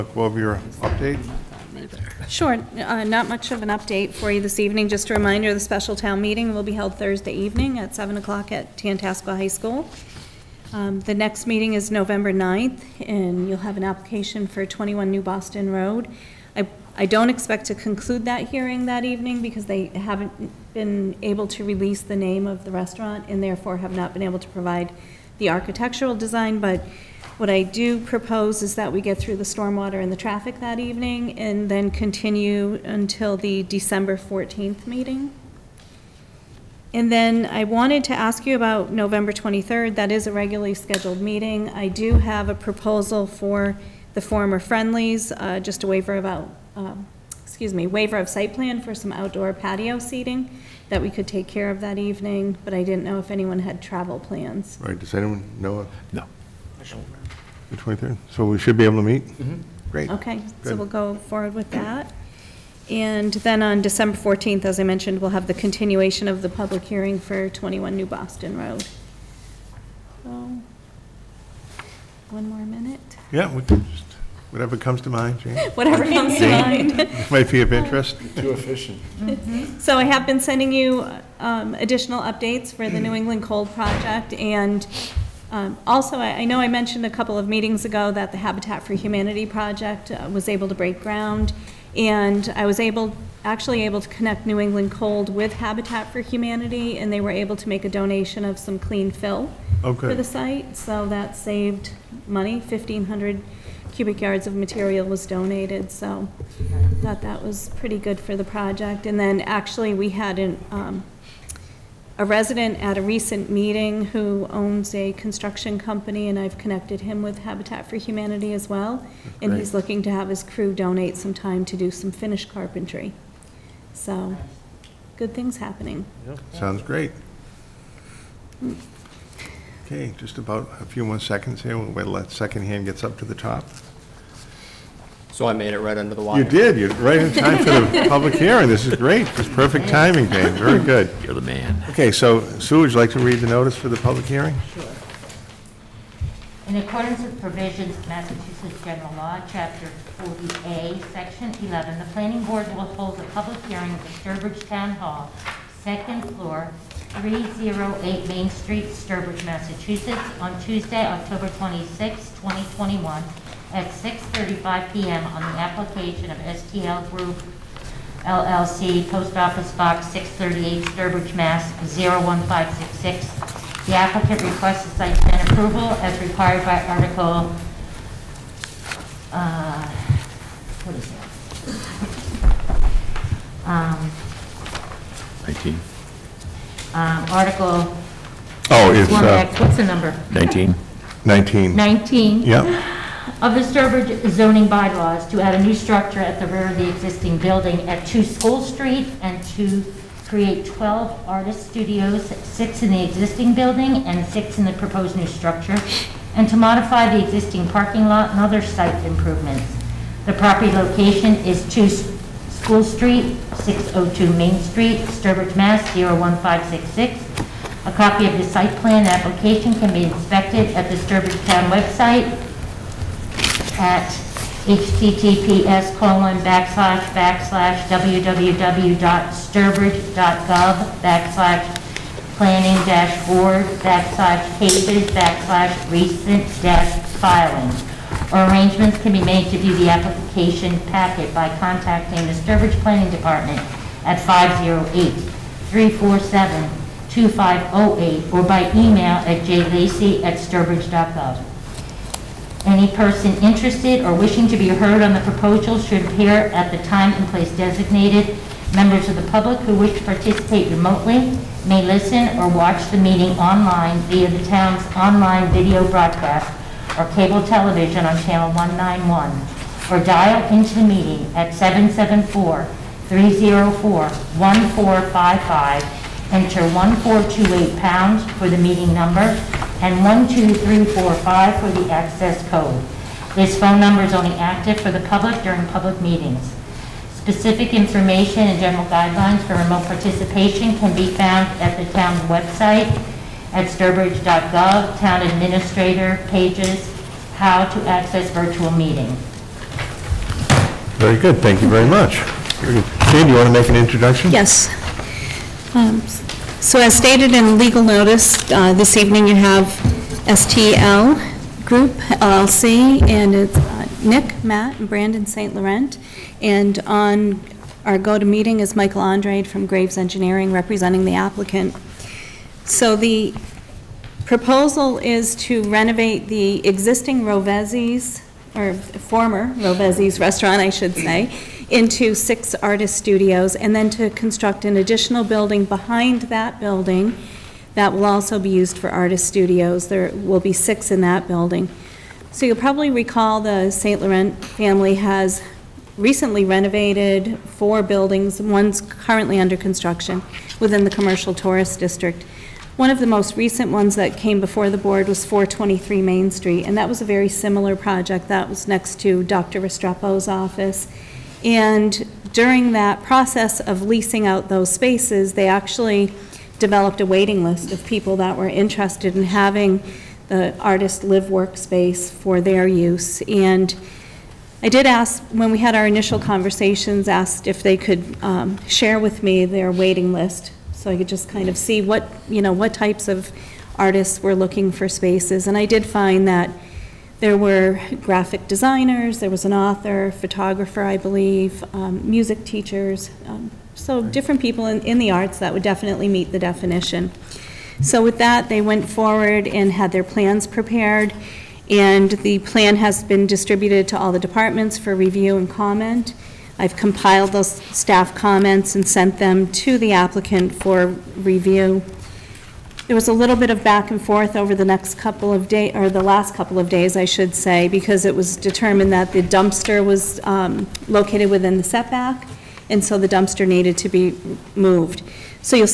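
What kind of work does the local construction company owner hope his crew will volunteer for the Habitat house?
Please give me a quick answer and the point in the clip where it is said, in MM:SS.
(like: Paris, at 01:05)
finished carpentry, at 02:02.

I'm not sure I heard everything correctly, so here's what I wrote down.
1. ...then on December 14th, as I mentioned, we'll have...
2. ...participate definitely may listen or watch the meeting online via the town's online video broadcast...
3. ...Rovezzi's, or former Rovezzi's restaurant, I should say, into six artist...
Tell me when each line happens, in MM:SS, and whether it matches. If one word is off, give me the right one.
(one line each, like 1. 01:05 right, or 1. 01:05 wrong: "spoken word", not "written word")
1. 01:03 right
2. 04:20 wrong: "remotely", not "definitely"
3. 05:27 right.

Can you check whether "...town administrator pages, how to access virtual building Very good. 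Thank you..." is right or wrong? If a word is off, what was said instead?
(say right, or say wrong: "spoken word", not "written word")
wrong: "meeting", not "building".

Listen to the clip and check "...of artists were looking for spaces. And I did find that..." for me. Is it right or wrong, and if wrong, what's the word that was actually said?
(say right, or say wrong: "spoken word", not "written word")
right.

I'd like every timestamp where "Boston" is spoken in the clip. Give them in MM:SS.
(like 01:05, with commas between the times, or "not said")
00:15, 01:08.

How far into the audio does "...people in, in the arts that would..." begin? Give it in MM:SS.
06:34.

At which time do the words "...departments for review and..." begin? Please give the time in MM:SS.
06:44.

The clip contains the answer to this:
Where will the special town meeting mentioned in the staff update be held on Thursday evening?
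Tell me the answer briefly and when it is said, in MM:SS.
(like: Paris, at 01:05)
Tantasqua High School, at 00:08.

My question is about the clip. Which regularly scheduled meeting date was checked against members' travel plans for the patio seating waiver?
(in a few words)
November 23rd.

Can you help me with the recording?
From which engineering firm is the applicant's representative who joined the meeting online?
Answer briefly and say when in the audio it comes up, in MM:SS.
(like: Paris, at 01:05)
Graves Engineering, at 05:19.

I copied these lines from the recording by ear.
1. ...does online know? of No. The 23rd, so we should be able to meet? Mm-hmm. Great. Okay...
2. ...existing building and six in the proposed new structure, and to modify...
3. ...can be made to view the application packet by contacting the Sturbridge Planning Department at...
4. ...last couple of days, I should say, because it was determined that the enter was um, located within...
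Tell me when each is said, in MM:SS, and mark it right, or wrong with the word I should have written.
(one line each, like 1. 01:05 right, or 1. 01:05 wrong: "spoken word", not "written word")
1. 00:54 wrong: "anyone", not "online"
2. 03:23 right
3. 03:59 right
4. 06:56 wrong: "dumpster", not "enter".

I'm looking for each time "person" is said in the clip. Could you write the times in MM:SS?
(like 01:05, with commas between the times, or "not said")
04:12.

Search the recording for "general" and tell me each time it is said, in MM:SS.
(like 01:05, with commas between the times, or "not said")
02:28, 04:48.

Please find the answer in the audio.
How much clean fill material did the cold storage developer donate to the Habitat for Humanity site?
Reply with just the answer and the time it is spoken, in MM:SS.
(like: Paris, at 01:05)
1,500 cubic yards, at 01:42.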